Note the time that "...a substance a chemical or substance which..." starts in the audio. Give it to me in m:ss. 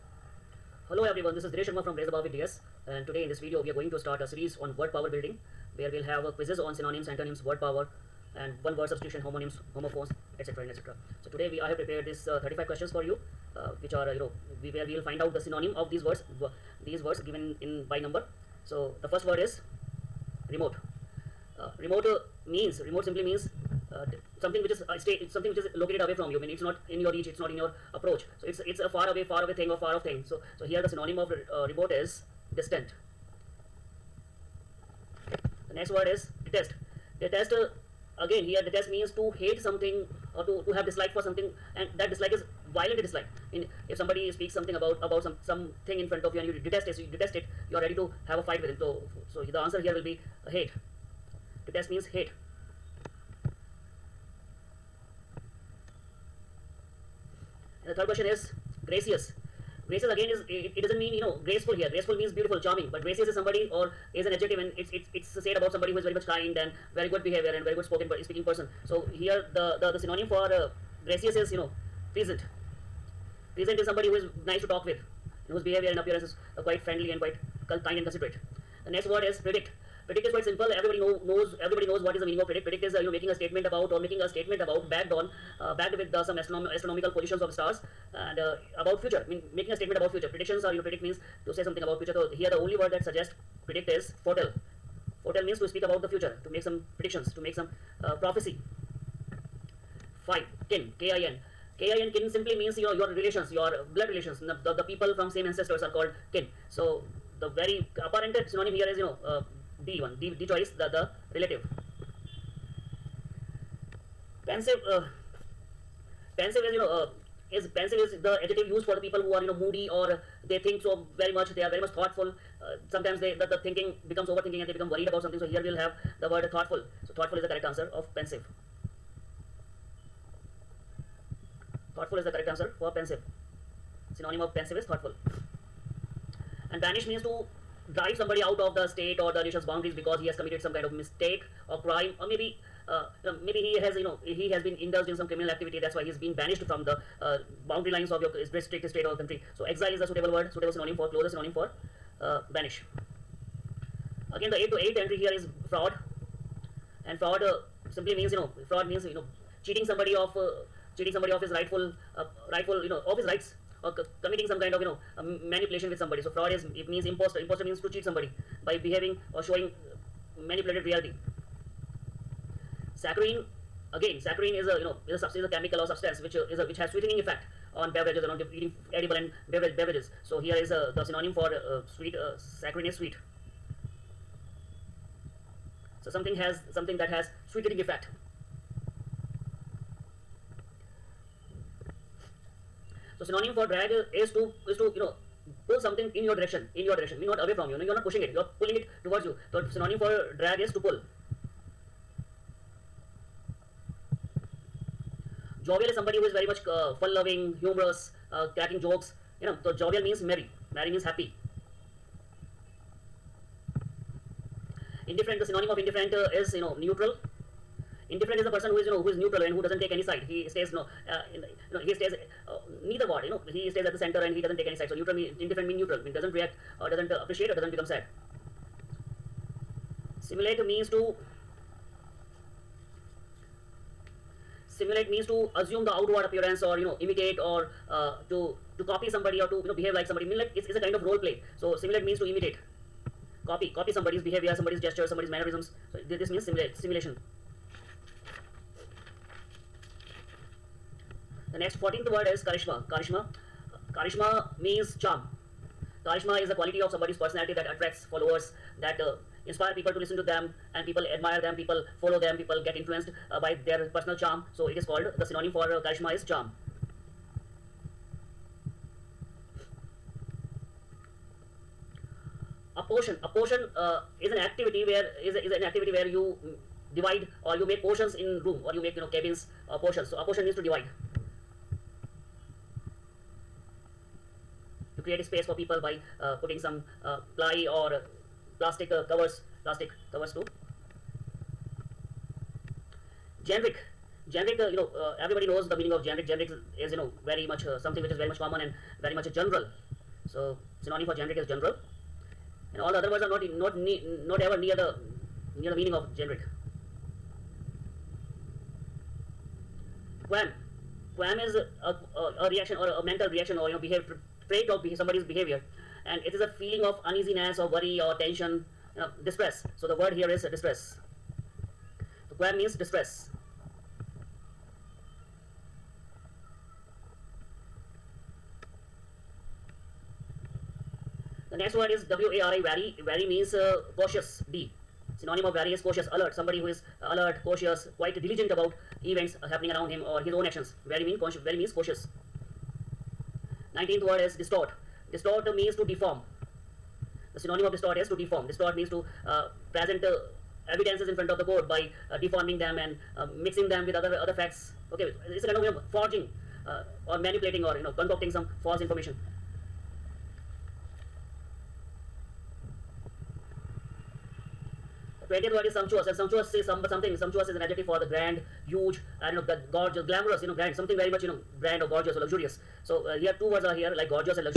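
2:55.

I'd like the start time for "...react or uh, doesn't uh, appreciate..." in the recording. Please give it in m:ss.
3:46.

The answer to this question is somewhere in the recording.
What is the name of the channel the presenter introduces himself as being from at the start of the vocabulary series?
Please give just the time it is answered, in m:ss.
0:01.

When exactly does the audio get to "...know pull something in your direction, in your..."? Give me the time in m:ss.
3:14.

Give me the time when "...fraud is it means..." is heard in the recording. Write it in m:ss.
2:46.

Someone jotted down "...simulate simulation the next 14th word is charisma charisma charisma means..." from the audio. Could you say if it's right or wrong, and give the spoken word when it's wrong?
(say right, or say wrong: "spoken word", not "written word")
right.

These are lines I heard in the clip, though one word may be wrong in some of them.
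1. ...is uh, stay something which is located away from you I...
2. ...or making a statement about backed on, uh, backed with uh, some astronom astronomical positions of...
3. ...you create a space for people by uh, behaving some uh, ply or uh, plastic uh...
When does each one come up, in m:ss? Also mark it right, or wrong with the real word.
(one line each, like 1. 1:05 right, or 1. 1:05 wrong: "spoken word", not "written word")
1. 0:24 right
2. 1:23 right
3. 4:44 wrong: "putting", not "behaving".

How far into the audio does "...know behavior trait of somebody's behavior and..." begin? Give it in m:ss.
5:13.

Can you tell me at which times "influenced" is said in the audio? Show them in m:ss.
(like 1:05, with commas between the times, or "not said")
4:22.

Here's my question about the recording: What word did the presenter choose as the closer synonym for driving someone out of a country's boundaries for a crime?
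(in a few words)
Exile.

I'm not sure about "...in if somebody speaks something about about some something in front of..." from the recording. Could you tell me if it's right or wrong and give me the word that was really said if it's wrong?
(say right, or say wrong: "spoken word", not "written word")
right.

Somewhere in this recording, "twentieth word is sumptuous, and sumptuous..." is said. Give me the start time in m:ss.
6:05.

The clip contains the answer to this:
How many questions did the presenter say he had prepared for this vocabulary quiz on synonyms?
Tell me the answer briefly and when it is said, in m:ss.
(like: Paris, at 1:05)
35, at 0:12.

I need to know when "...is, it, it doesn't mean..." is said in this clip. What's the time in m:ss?
1:00.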